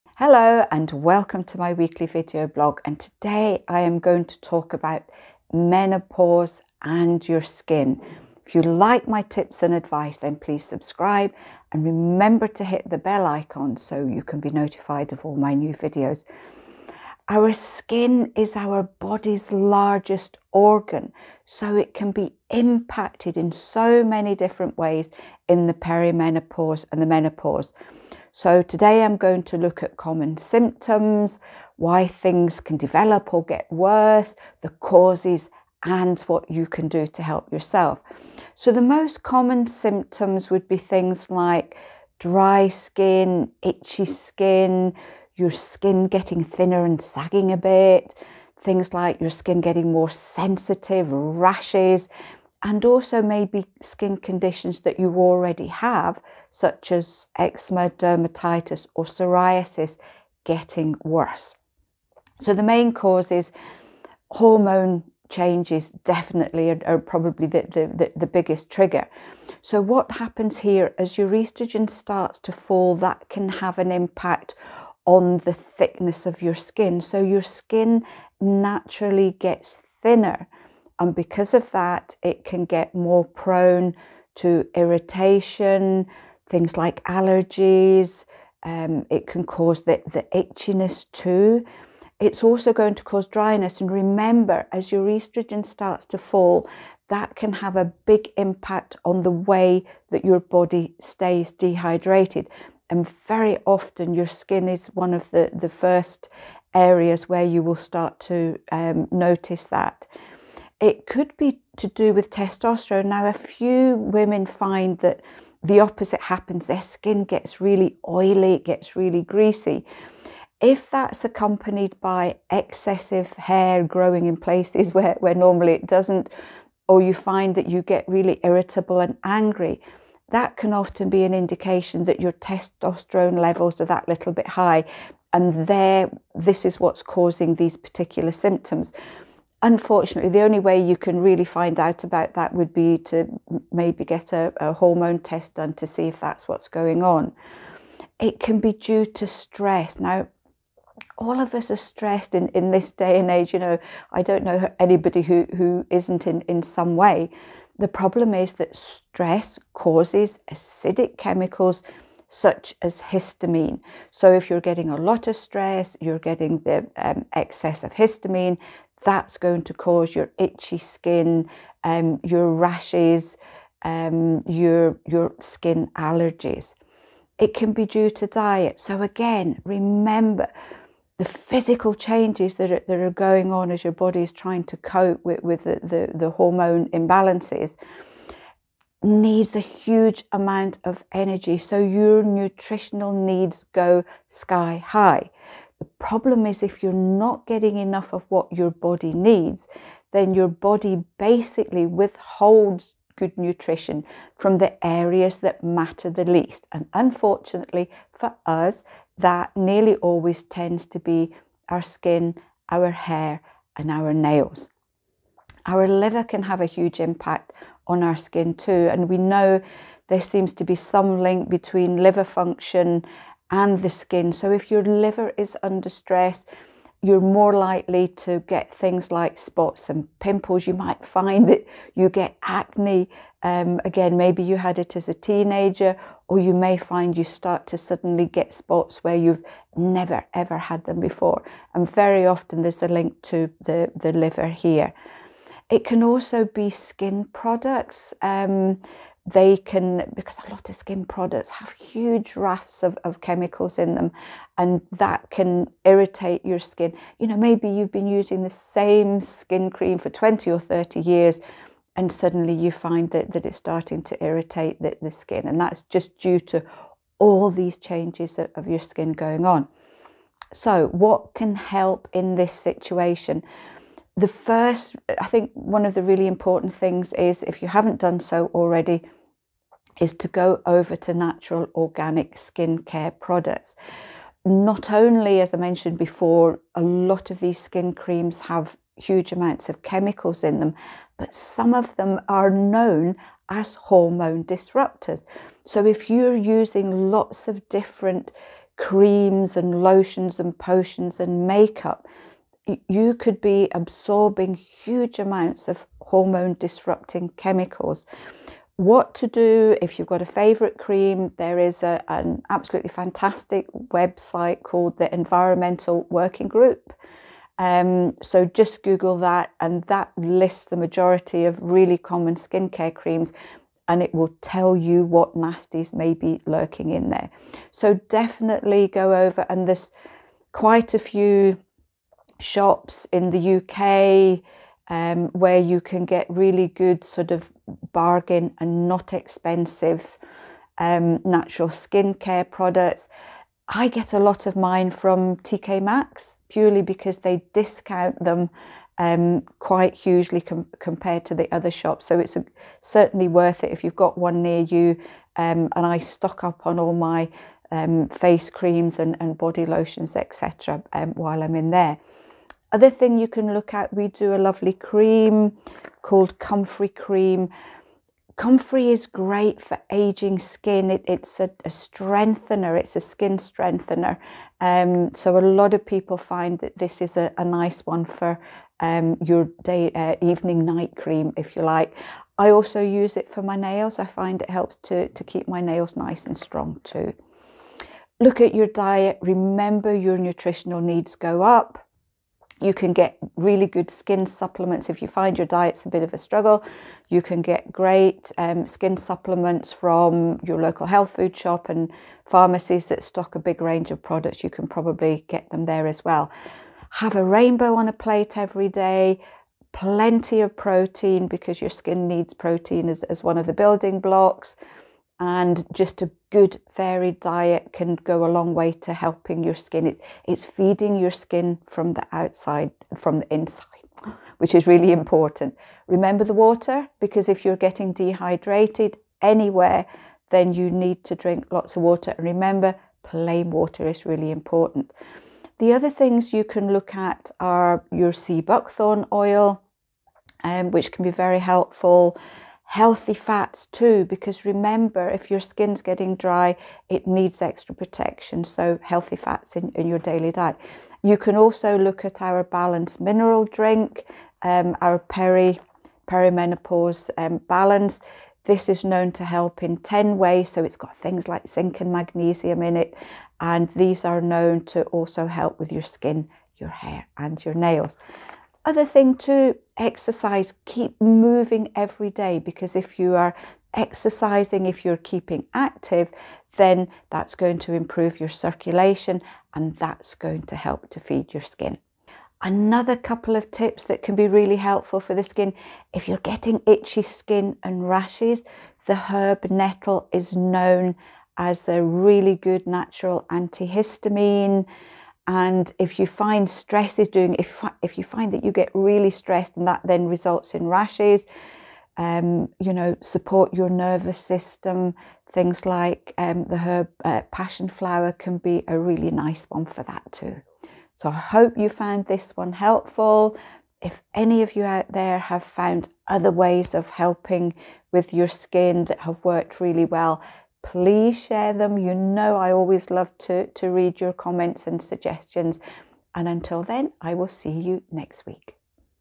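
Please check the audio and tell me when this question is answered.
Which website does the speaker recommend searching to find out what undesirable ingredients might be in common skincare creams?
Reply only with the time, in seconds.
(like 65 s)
315 s.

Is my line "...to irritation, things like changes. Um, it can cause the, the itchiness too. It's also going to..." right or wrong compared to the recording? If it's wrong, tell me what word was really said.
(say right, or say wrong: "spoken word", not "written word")
wrong: "allergies", not "changes".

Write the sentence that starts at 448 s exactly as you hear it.
So, healthy fats in, in your daily diet.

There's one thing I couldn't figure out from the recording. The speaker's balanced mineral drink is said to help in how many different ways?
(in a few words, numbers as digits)
10.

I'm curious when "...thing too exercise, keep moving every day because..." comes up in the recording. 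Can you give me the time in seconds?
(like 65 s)
468 s.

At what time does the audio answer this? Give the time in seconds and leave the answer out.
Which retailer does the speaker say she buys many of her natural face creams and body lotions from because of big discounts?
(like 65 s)
345 s.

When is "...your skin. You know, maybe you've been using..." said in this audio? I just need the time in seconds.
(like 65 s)
256 s.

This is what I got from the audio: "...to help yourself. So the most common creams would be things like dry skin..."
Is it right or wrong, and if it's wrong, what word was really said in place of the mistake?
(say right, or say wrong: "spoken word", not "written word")
wrong: "symptoms", not "creams".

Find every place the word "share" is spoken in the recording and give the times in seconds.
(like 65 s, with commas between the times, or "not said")
521 s.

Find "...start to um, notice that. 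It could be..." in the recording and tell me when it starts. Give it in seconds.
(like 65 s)
107 s.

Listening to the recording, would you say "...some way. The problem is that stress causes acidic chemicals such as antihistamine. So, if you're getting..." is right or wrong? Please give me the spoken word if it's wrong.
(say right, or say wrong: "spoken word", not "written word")
wrong: "histamine", not "antihistamine".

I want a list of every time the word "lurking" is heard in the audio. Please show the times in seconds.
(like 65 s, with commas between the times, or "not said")
326 s.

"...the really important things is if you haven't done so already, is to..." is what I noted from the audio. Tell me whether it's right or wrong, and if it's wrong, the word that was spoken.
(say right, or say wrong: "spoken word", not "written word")
right.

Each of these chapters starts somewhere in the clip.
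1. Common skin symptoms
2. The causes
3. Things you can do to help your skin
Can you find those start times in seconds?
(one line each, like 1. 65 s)
1. 38 s
2. 62 s
3. 270 s.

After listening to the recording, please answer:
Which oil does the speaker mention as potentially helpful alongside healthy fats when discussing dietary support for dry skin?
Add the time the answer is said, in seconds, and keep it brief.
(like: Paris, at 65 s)
sea buckthorn oil, at 438 s.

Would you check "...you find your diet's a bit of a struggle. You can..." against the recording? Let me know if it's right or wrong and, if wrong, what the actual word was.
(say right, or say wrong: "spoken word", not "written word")
right.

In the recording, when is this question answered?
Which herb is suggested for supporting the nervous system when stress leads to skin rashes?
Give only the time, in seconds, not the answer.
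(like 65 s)
507 s.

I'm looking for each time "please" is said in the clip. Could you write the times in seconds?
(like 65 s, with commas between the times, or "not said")
10 s, 520 s.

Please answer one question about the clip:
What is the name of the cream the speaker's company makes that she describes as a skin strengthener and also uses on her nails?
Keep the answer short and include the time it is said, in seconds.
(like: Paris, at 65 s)
Comfrey Cream, at 366 s.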